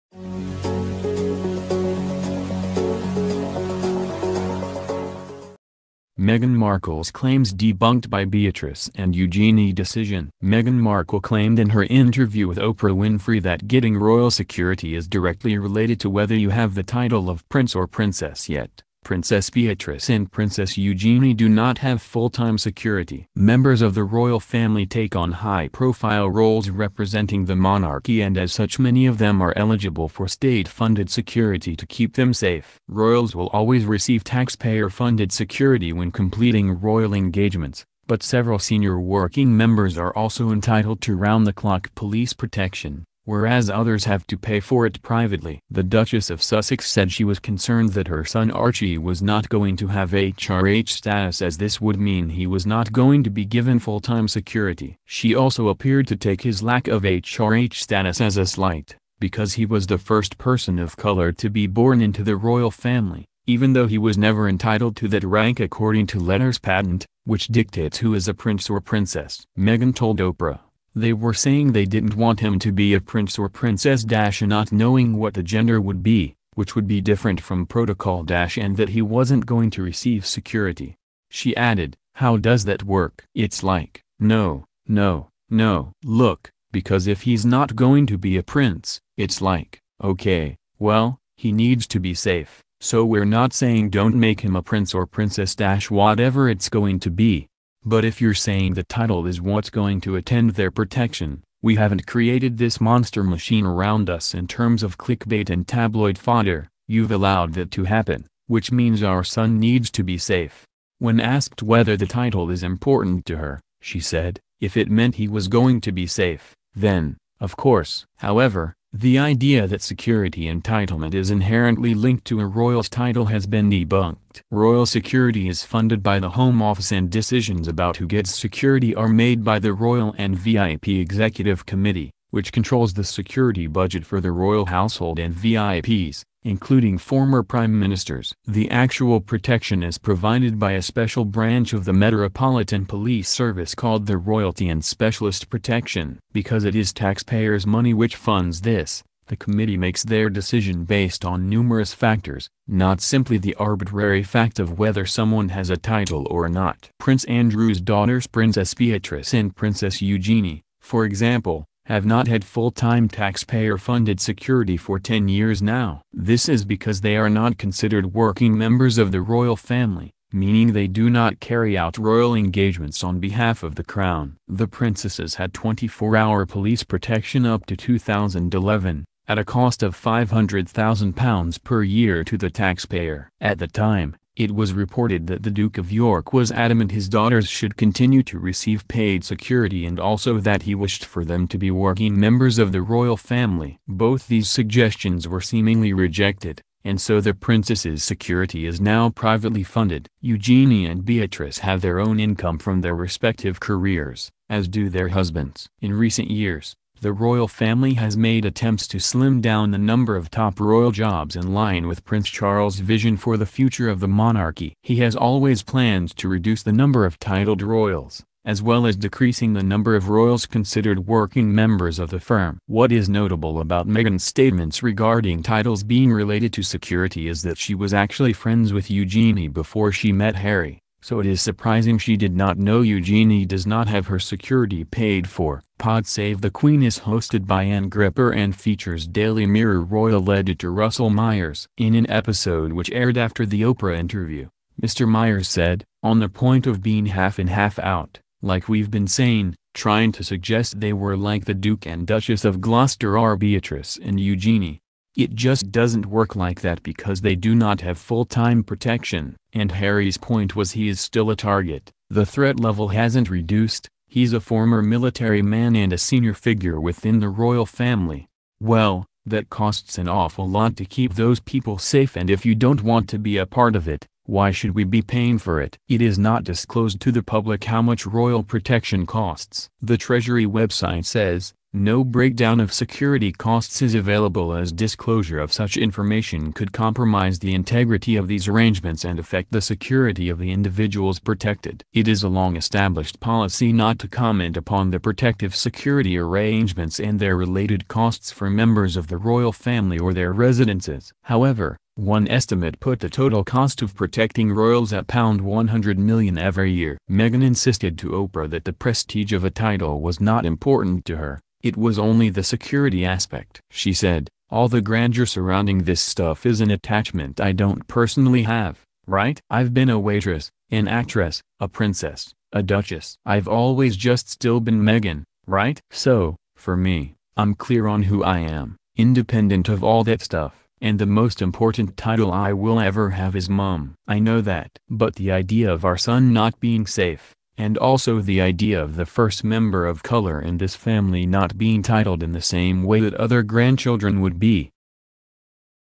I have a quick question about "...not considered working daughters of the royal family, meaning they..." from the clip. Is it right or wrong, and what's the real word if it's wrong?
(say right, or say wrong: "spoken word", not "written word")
wrong: "members", not "daughters".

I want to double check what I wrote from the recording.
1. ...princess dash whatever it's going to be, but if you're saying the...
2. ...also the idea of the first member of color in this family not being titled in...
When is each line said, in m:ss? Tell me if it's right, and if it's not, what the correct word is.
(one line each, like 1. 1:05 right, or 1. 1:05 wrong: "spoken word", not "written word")
1. 1:35 right
2. 5:37 right.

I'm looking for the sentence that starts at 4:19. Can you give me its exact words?
And Harry's point was he is still a target.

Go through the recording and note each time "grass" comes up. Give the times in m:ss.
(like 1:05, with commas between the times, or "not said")
not said.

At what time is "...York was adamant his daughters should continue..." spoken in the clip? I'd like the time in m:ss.
3:05.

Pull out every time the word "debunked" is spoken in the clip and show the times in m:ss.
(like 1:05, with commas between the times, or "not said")
0:07, 2:03.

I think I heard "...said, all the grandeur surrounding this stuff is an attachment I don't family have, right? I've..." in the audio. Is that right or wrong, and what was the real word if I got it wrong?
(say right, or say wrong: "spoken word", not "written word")
wrong: "personally", not "family".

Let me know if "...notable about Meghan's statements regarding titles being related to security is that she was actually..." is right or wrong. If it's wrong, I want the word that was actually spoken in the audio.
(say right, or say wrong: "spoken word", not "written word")
right.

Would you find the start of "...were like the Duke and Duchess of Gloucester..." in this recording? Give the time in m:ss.
4:10.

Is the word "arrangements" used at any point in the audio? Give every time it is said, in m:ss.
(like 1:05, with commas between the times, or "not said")
4:48, 4:56.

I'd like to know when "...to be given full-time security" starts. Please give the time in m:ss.
0:53.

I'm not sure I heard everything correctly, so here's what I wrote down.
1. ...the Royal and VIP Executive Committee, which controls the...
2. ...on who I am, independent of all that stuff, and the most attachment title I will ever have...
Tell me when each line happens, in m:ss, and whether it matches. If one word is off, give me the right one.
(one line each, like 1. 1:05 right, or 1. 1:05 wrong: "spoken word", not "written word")
1. 2:09 right
2. 5:27 wrong: "important", not "attachment".